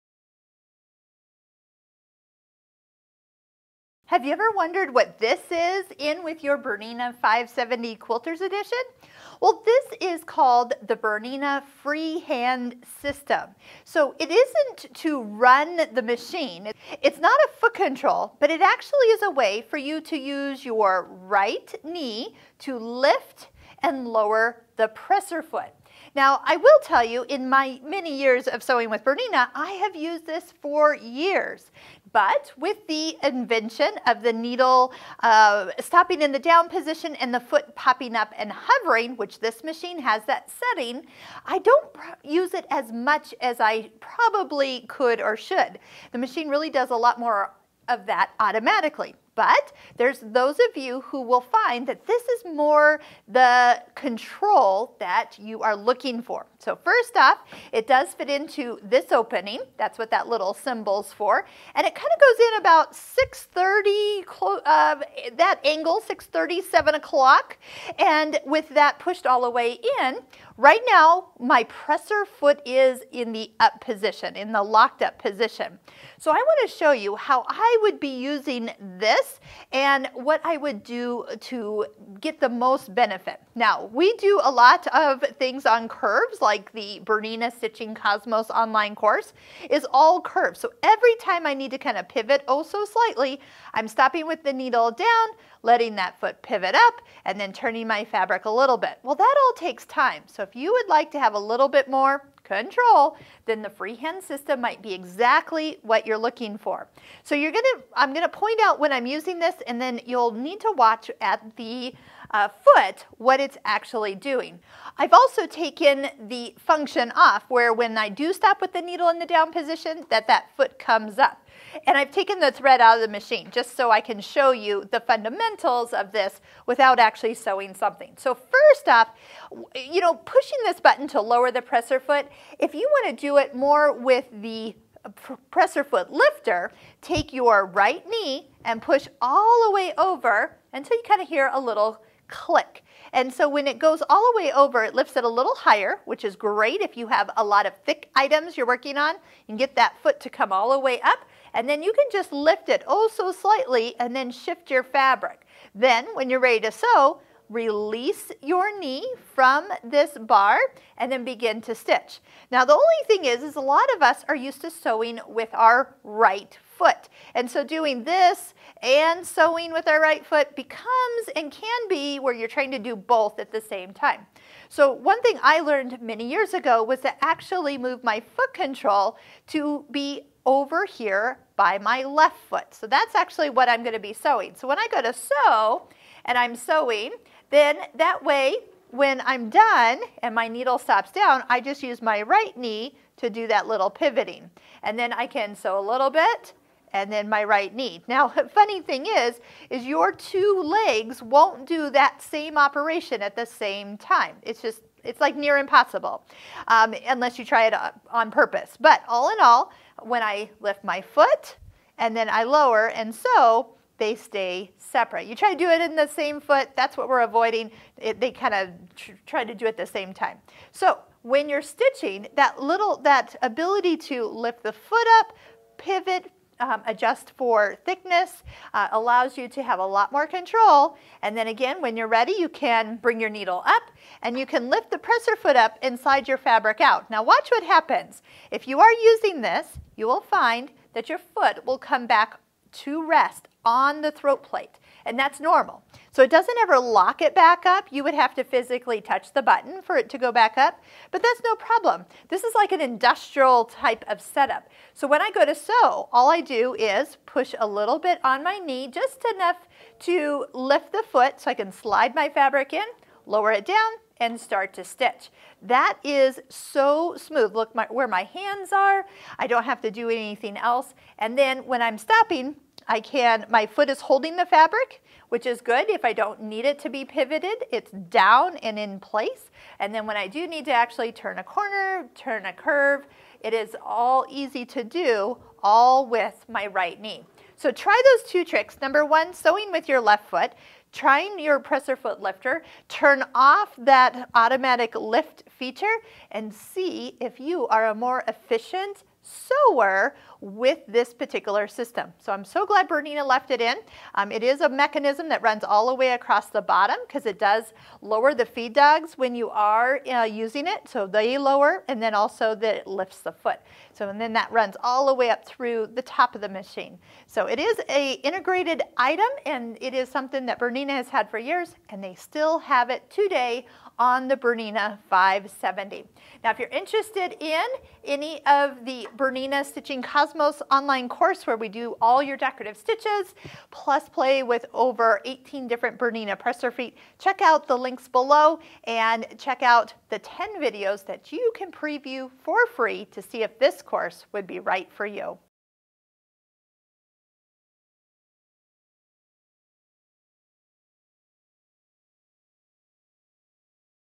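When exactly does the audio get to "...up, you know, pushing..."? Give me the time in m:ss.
2:08.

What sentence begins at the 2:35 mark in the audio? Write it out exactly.
Then when you're ready to sew, release your knee from this bar and then begin to stitch.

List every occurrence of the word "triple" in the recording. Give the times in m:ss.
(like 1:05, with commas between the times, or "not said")
not said.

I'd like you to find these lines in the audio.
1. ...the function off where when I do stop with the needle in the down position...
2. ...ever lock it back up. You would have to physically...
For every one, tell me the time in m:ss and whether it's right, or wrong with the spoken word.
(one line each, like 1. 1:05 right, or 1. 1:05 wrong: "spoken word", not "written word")
1. 1:56 right
2. 4:06 right.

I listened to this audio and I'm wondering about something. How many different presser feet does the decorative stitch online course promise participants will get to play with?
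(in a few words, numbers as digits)
18.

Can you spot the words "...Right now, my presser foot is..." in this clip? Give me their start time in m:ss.
1:10.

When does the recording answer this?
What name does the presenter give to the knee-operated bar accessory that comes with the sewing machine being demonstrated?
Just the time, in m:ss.
0:10.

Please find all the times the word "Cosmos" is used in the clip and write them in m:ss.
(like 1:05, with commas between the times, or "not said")
1:27, 5:30.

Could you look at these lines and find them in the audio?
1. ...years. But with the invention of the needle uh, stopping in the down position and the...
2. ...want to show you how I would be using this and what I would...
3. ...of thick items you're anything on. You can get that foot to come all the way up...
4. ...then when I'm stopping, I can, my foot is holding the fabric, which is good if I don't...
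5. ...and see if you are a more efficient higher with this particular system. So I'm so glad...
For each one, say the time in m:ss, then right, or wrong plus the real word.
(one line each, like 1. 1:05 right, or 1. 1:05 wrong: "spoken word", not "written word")
1. 0:30 right
2. 1:16 right
3. 2:27 wrong: "working", not "anything"
4. 4:31 right
5. 4:56 wrong: "sewer", not "higher".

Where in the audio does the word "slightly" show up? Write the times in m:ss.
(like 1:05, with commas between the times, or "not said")
1:32, 2:33.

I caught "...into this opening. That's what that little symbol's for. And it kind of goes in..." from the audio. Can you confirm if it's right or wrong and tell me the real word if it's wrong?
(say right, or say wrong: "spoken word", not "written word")
right.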